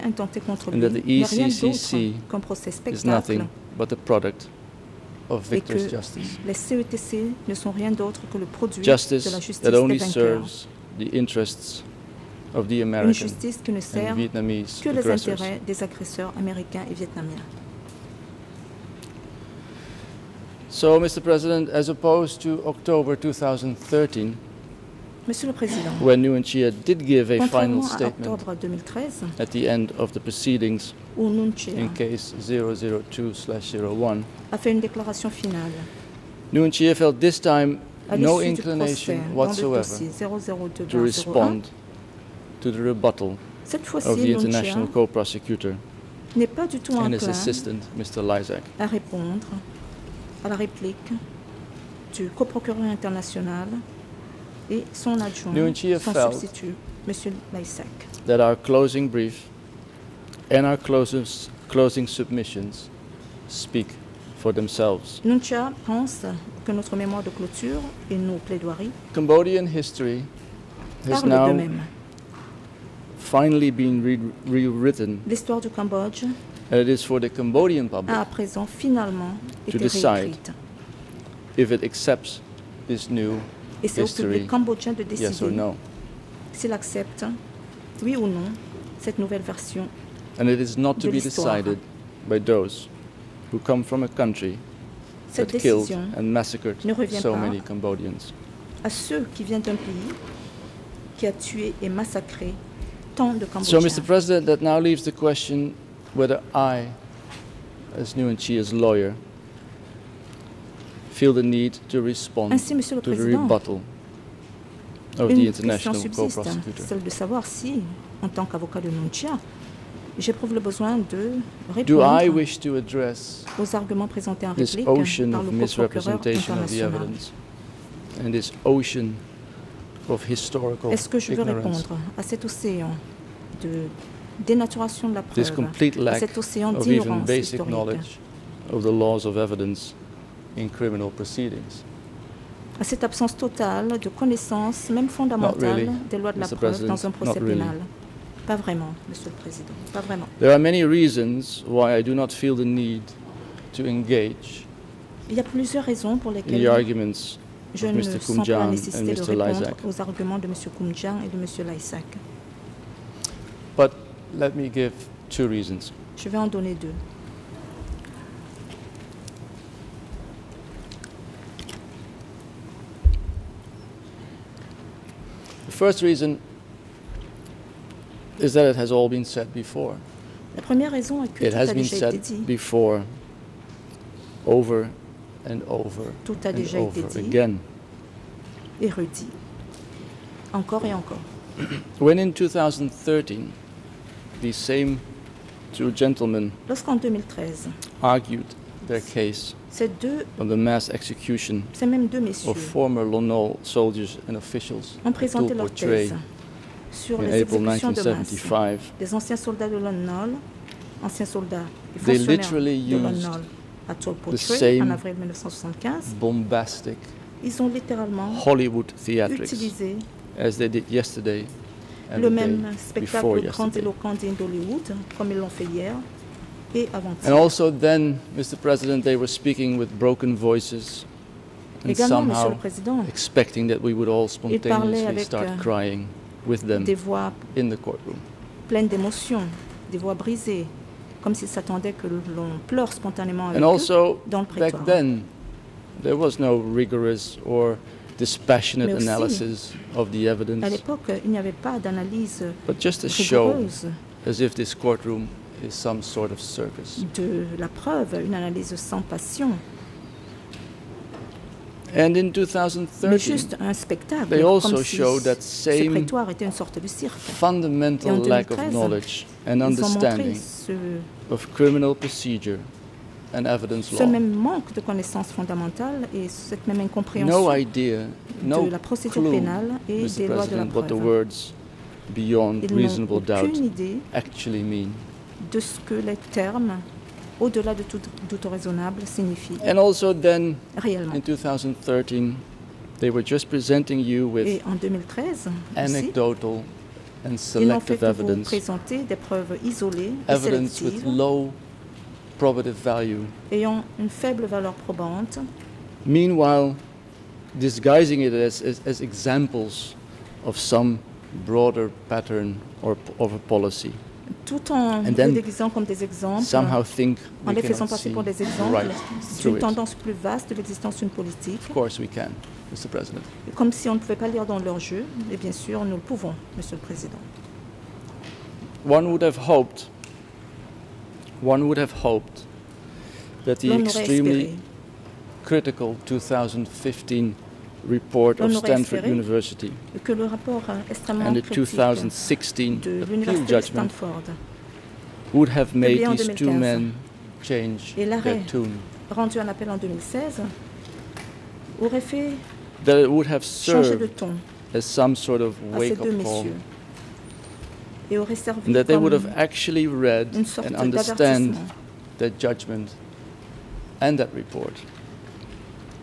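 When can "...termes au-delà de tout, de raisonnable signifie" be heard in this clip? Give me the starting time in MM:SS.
04:46.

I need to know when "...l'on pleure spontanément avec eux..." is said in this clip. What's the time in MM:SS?
04:02.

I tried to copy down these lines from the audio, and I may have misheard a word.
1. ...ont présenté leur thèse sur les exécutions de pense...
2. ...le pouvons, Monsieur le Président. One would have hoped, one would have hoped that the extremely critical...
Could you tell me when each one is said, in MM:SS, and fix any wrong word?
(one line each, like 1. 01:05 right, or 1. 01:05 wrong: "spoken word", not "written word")
1. 03:25 wrong: "masse", not "pense"
2. 05:25 right.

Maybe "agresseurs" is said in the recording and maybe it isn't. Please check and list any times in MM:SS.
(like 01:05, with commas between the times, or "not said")
00:15.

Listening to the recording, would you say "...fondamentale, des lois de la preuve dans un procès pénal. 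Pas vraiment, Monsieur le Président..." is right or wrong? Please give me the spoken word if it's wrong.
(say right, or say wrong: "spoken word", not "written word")
right.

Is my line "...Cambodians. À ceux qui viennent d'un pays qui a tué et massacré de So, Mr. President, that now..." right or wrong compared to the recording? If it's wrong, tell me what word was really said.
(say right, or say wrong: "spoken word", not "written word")
right.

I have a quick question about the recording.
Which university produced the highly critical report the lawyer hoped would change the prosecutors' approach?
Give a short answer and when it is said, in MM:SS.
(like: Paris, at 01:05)
Stanford University, at 05:38.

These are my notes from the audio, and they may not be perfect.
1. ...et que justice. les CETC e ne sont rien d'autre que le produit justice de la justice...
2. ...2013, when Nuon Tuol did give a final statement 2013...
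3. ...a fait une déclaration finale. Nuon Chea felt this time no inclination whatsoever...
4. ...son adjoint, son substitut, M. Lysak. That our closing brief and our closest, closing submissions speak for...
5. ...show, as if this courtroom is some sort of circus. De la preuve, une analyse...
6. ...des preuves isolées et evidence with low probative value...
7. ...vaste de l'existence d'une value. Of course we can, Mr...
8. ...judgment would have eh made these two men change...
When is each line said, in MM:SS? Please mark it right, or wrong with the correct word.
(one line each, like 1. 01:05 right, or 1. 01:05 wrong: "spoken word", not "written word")
1. 00:05 right
2. 00:23 wrong: "Chea", not "Tuol"
3. 00:34 right
4. 00:54 right
5. 04:13 right
6. 04:59 right
7. 05:20 wrong: "politique", not "value"
8. 05:43 right.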